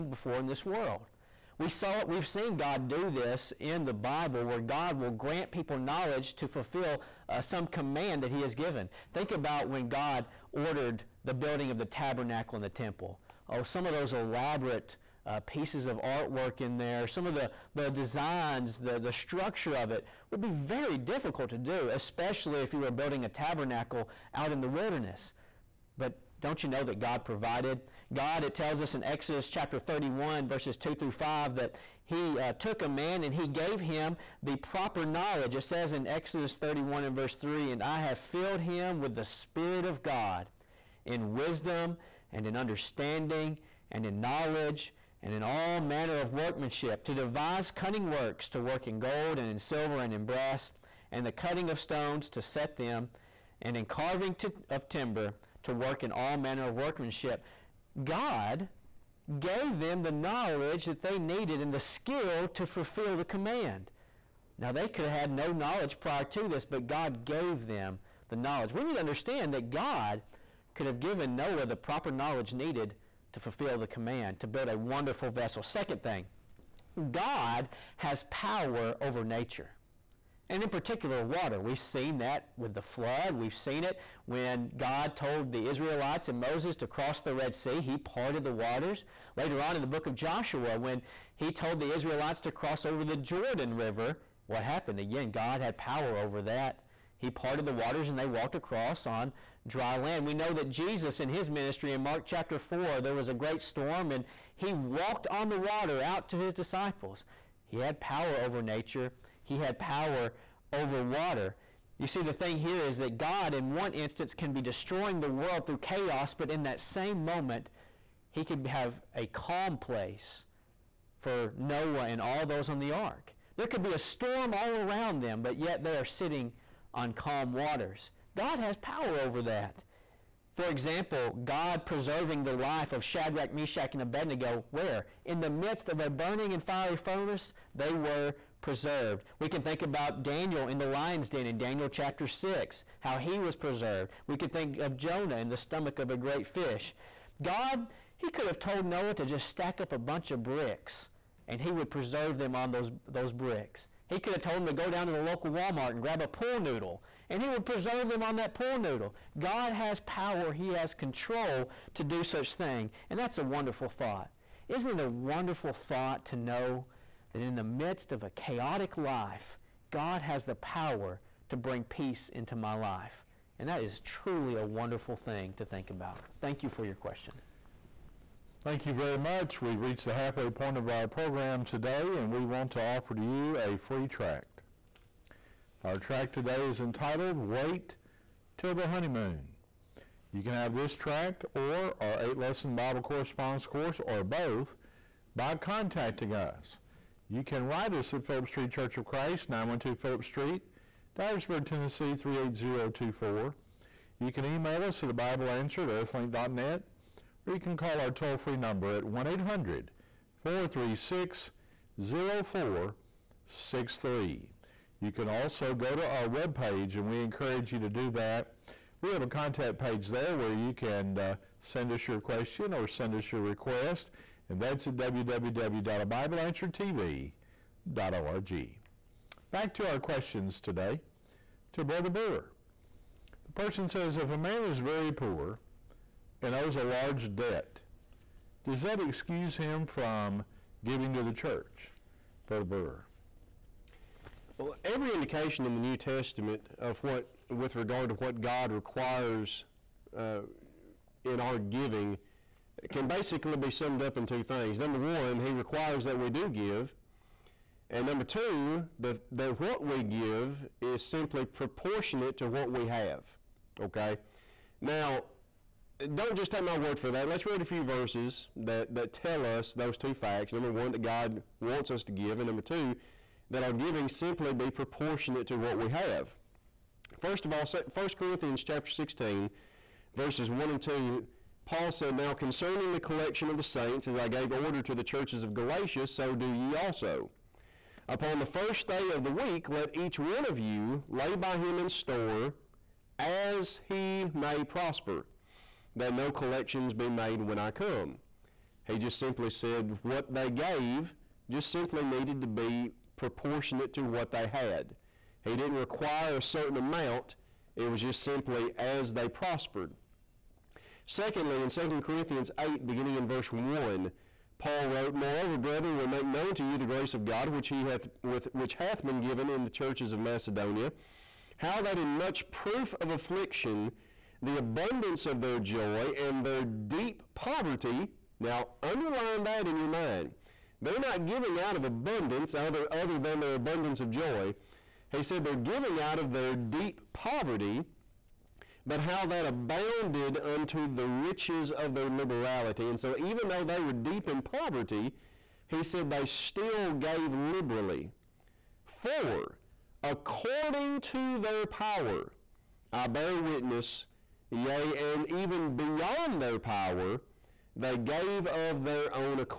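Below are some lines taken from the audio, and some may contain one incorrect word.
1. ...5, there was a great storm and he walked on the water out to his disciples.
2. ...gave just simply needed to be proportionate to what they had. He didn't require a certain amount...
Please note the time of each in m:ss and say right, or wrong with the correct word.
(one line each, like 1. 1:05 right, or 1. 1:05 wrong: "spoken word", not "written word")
1. 1:42 wrong: "4", not "5"
2. 5:00 right.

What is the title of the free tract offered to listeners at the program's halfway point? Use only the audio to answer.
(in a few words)
Wait Till the Honeymoon.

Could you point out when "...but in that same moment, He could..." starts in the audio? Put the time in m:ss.
1:56.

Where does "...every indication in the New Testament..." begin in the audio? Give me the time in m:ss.
4:04.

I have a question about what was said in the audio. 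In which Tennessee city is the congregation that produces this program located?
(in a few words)
Dyersburg.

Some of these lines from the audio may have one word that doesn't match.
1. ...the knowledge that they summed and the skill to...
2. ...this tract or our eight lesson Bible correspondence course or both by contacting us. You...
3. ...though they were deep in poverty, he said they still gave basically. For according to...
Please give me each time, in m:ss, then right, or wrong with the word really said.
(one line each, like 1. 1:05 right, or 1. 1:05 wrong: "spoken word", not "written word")
1. 1:00 wrong: "needed", not "summed"
2. 3:10 right
3. 5:43 wrong: "liberally", not "basically".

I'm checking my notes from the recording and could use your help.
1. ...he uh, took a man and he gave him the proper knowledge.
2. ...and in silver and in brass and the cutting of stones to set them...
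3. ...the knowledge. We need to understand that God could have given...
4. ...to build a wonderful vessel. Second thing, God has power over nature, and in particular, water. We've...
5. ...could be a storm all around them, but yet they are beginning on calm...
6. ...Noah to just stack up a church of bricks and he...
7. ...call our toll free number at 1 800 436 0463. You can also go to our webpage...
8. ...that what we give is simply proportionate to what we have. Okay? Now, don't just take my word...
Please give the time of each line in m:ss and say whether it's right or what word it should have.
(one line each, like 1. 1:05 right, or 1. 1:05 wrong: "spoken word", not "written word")
1. 0:32 right
2. 0:49 right
3. 1:08 right
4. 1:14 right
5. 2:03 wrong: "sitting", not "beginning"
6. 2:28 wrong: "bunch", not "church"
7. 3:27 right
8. 4:19 right.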